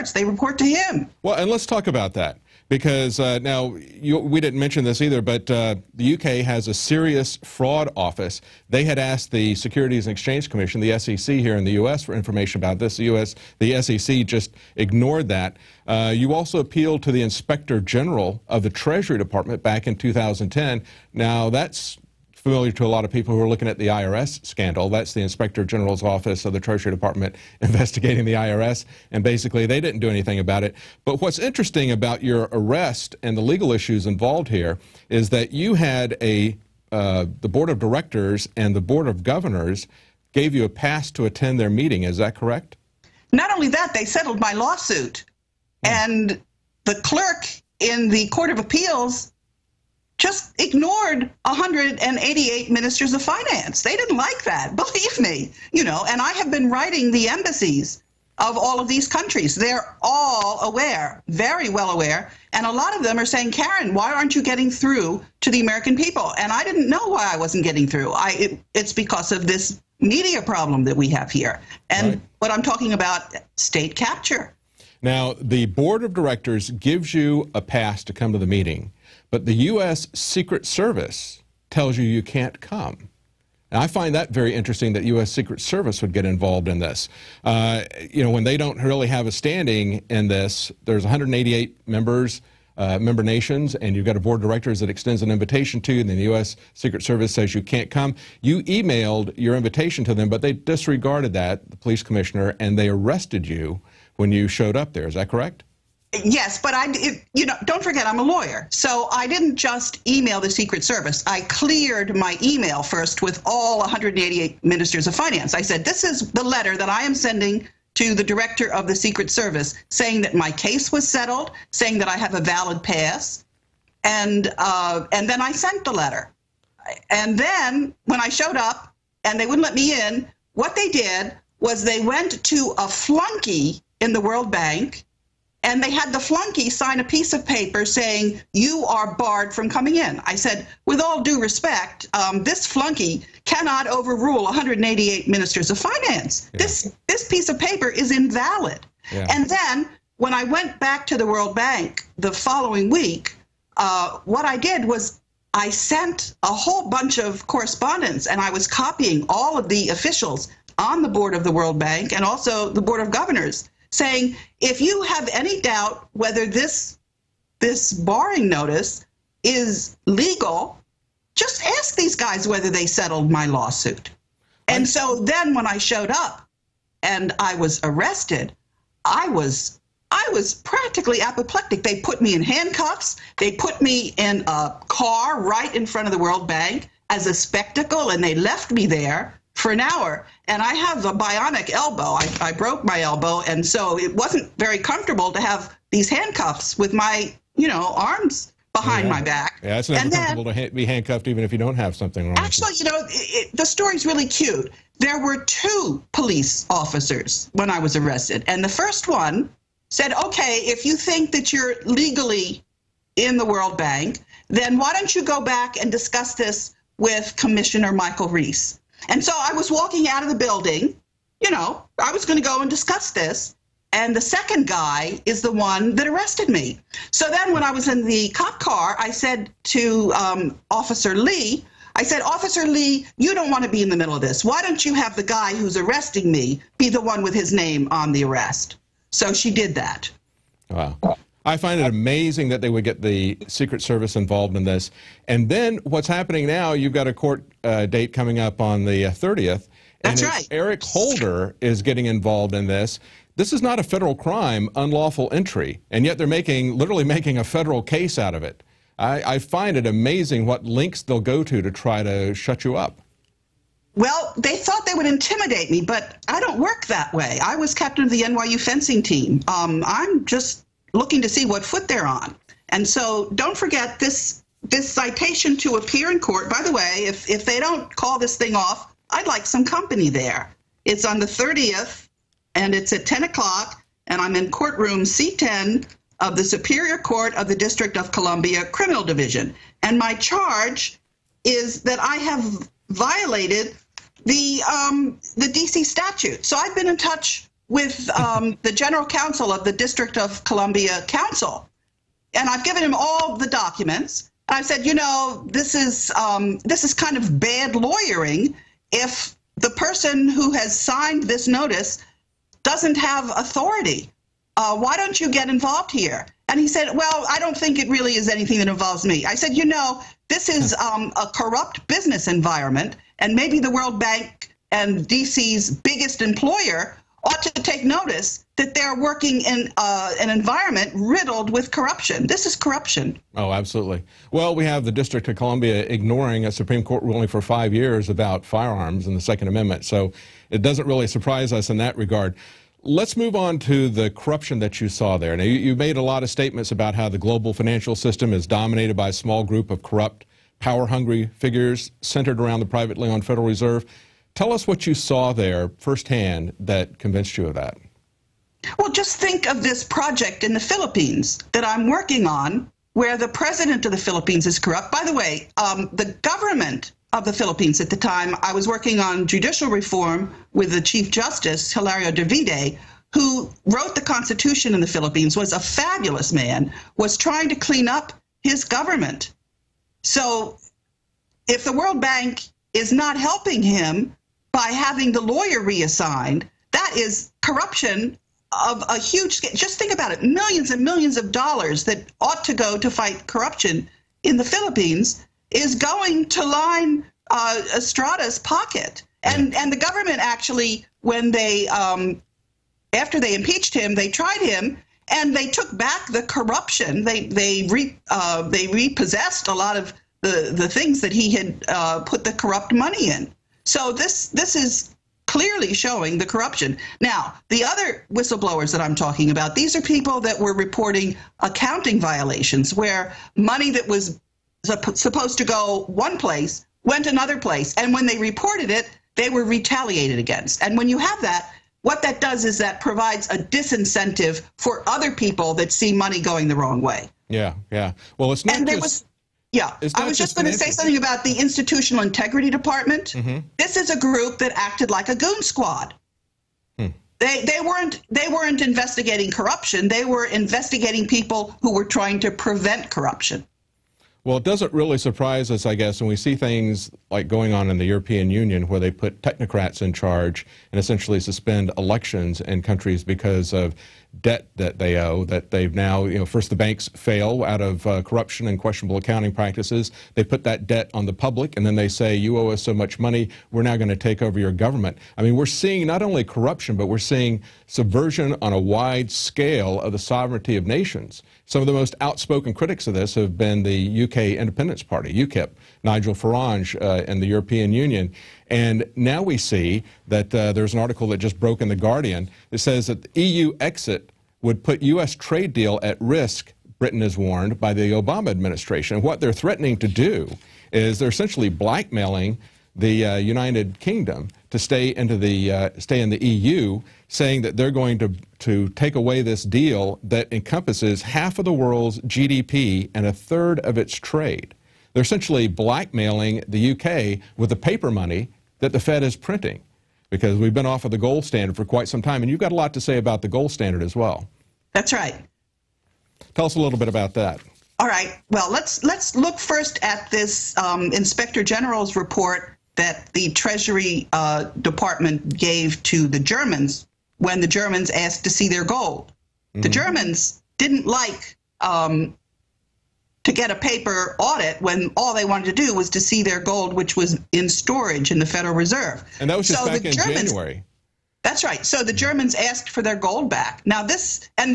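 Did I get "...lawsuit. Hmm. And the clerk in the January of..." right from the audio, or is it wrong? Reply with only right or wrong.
wrong.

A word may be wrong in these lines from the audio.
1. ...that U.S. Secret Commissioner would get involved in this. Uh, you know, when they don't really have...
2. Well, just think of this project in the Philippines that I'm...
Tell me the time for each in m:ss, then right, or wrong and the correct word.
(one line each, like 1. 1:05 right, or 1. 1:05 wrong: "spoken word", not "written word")
1. 1:24 wrong: "Service", not "Commissioner"
2. 5:58 right.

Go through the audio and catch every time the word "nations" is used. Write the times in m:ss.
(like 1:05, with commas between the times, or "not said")
1:33, 8:00.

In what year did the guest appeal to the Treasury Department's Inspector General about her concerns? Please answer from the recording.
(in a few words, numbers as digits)
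2010.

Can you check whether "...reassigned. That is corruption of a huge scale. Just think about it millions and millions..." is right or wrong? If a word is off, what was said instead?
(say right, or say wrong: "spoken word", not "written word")
right.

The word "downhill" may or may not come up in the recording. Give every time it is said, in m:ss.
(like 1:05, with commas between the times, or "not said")
not said.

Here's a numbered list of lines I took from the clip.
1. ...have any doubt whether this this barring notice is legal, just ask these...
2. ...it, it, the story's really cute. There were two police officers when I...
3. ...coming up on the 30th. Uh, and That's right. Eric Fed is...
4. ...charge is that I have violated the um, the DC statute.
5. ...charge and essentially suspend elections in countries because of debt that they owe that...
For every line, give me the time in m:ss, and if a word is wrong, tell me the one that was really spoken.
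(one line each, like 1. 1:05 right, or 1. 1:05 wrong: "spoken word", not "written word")
1. 2:45 right
2. 3:22 right
3. 4:08 wrong: "Holder", not "Fed"
4. 4:50 right
5. 7:39 right.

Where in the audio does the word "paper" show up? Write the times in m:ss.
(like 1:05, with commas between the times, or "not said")
2:17, 2:27, 8:37, 9:03.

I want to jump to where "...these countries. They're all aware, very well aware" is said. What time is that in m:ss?
0:58.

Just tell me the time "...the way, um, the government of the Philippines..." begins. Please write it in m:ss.
6:05.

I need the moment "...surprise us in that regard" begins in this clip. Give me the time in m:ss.
5:41.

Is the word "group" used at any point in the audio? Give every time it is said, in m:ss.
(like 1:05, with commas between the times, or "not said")
5:49, 7:23.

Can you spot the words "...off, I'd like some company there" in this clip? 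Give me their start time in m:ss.
4:38.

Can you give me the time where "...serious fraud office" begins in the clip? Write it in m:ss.
0:06.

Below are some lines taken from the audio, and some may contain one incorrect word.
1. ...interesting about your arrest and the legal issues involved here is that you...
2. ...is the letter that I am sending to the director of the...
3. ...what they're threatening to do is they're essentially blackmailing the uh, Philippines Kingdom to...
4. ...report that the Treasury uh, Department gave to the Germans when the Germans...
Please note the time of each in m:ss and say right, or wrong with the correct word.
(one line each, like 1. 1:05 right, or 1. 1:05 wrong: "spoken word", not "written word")
1. 0:31 right
2. 1:56 right
3. 8:19 wrong: "United", not "Philippines"
4. 8:51 right.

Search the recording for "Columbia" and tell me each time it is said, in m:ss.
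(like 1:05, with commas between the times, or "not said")
4:48, 5:00, 5:35.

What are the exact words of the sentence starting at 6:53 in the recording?
So this this is clearly showing the corruption.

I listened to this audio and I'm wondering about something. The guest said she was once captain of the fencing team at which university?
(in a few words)
NYU.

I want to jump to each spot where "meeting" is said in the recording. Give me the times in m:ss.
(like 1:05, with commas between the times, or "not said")
0:41, 1:18.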